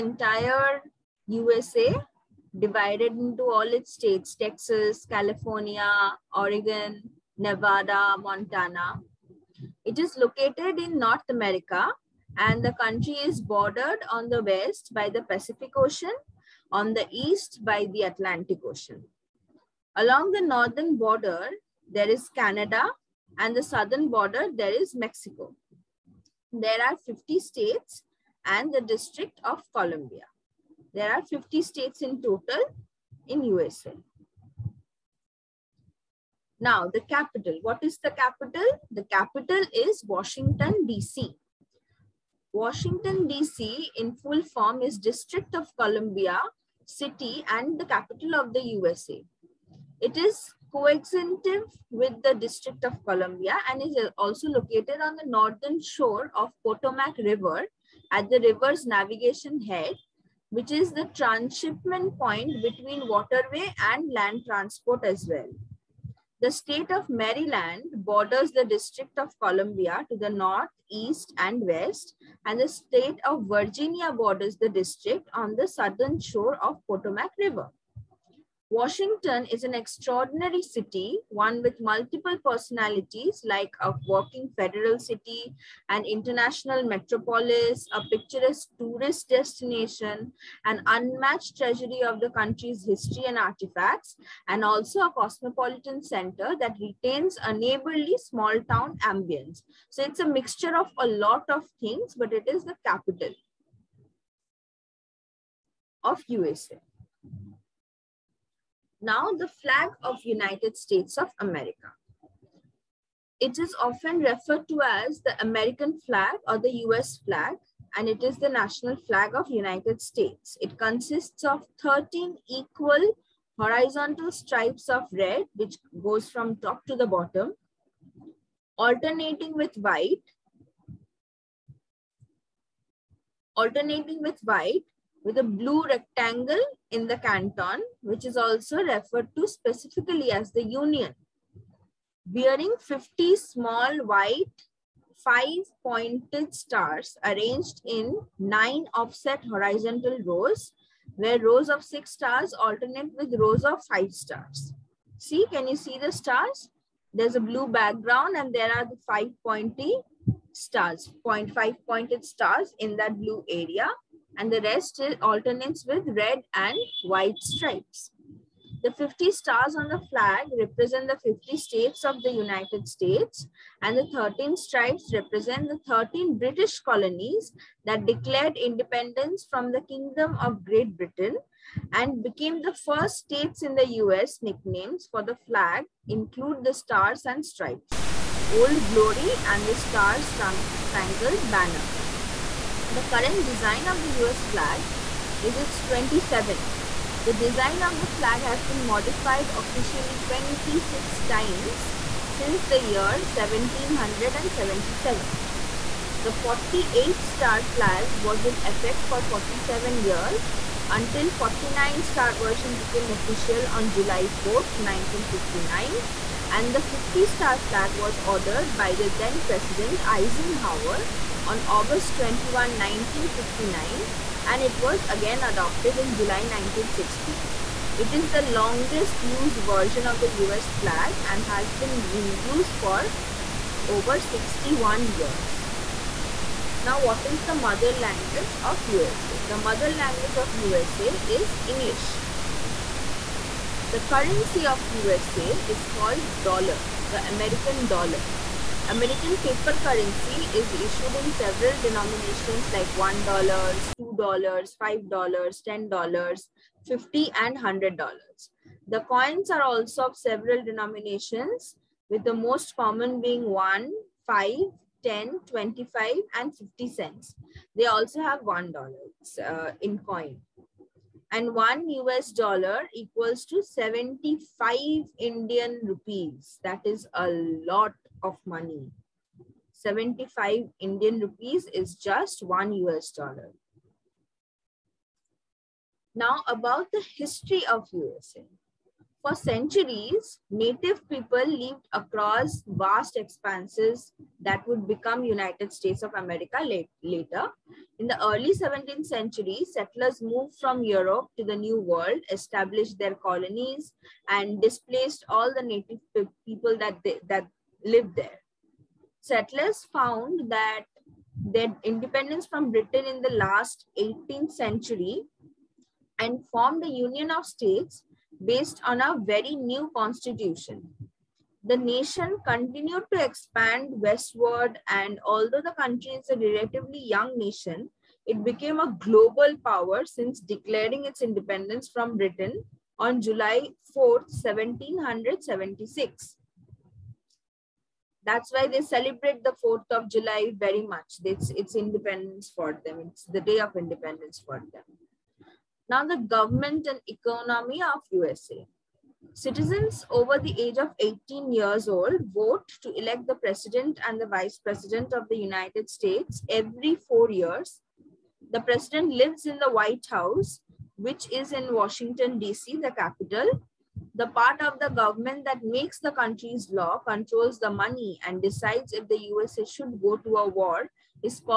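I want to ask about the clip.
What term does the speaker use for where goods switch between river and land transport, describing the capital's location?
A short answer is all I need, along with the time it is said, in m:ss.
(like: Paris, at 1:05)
transshipment point, at 1:01.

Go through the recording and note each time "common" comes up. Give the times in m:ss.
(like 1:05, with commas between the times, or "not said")
4:22.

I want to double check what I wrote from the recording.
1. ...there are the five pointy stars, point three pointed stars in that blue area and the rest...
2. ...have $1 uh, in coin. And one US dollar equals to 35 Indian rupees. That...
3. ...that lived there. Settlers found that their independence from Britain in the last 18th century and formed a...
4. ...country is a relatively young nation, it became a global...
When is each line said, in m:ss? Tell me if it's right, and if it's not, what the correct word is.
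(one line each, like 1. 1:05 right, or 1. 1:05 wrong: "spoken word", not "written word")
1. 2:38 wrong: "five", not "three"
2. 4:28 wrong: "75", not "35"
3. 5:07 right
4. 5:25 right.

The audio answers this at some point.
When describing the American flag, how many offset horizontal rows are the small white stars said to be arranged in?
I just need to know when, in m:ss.
2:28.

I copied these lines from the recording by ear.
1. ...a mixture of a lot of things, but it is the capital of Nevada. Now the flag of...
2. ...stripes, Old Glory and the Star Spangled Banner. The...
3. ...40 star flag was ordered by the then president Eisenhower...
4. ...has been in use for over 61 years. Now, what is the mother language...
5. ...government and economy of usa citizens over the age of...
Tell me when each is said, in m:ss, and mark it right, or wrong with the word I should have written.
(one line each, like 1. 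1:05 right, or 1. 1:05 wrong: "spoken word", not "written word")
1. 1:40 wrong: "USA", not "Nevada"
2. 3:07 right
3. 3:36 wrong: "50", not "40"
4. 3:51 right
5. 5:46 right.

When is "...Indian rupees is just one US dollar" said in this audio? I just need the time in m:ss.
4:40.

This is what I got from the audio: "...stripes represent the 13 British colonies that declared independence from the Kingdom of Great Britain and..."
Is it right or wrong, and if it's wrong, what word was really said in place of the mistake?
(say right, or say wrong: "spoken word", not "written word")
right.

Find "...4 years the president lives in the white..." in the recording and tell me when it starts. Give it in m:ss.
5:56.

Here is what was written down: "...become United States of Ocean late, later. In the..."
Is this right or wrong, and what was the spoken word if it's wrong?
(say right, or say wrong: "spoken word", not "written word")
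wrong: "America", not "Ocean".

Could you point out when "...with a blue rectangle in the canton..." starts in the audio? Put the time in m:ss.
2:15.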